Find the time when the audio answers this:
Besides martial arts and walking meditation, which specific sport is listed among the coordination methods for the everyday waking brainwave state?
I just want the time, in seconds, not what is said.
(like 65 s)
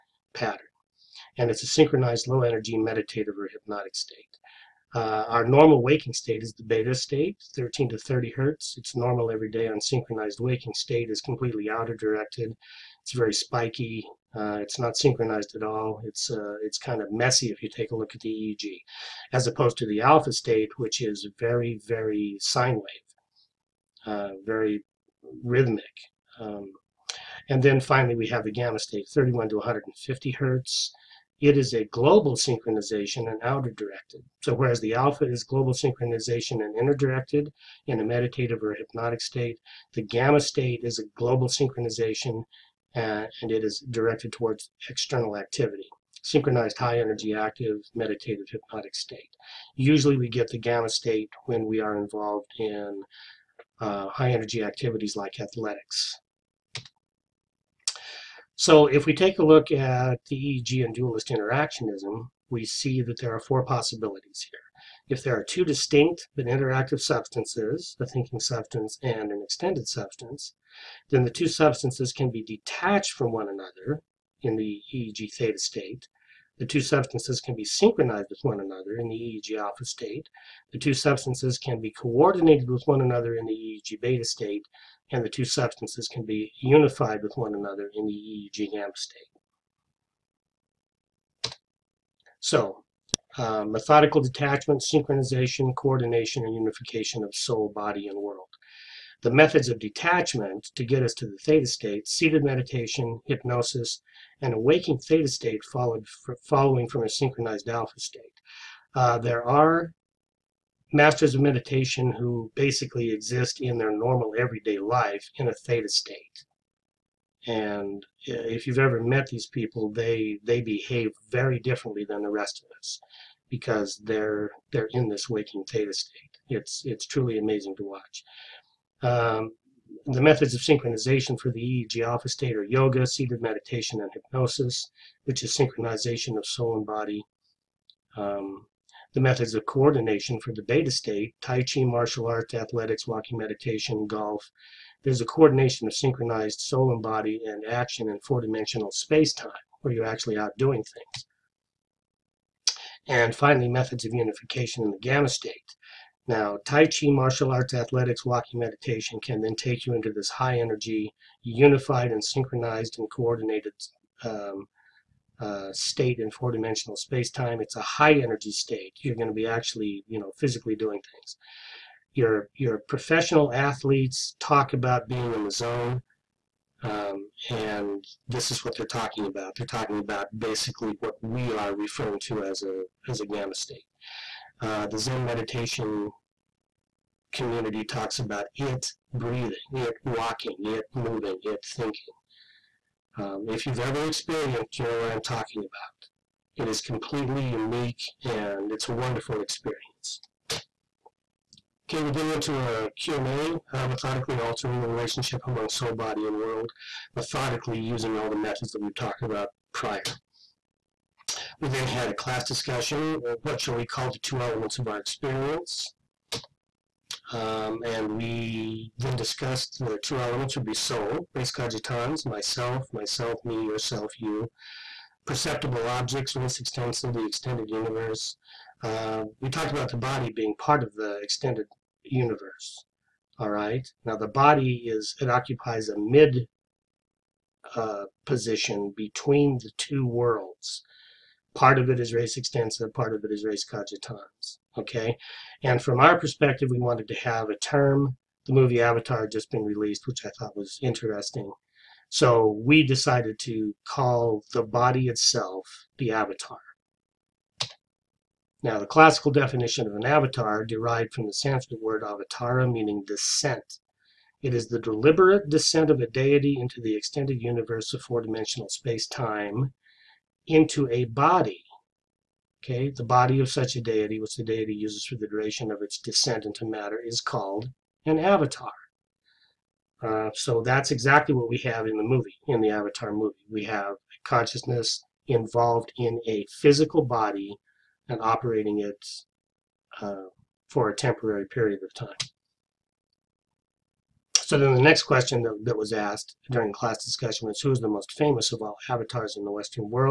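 144 s.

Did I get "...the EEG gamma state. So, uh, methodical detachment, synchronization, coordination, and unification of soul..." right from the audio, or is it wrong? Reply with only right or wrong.
right.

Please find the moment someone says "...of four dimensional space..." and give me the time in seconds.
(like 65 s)
267 s.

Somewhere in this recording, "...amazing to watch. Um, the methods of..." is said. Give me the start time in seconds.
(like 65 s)
127 s.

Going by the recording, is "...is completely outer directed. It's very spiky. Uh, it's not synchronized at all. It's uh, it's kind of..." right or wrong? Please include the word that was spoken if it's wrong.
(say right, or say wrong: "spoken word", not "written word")
right.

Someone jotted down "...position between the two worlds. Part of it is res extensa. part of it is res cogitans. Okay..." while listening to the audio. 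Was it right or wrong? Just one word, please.
right.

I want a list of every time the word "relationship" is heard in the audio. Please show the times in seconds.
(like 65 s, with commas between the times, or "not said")
204 s.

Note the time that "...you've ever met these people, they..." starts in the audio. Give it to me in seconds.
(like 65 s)
118 s.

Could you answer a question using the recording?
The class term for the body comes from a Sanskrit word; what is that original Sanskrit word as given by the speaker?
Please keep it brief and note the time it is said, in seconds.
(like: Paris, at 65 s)
avatara, at 262 s.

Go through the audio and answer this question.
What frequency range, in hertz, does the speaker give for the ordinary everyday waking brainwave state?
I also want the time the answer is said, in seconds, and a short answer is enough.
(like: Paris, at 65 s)
13 to 30 hertz, at 7 s.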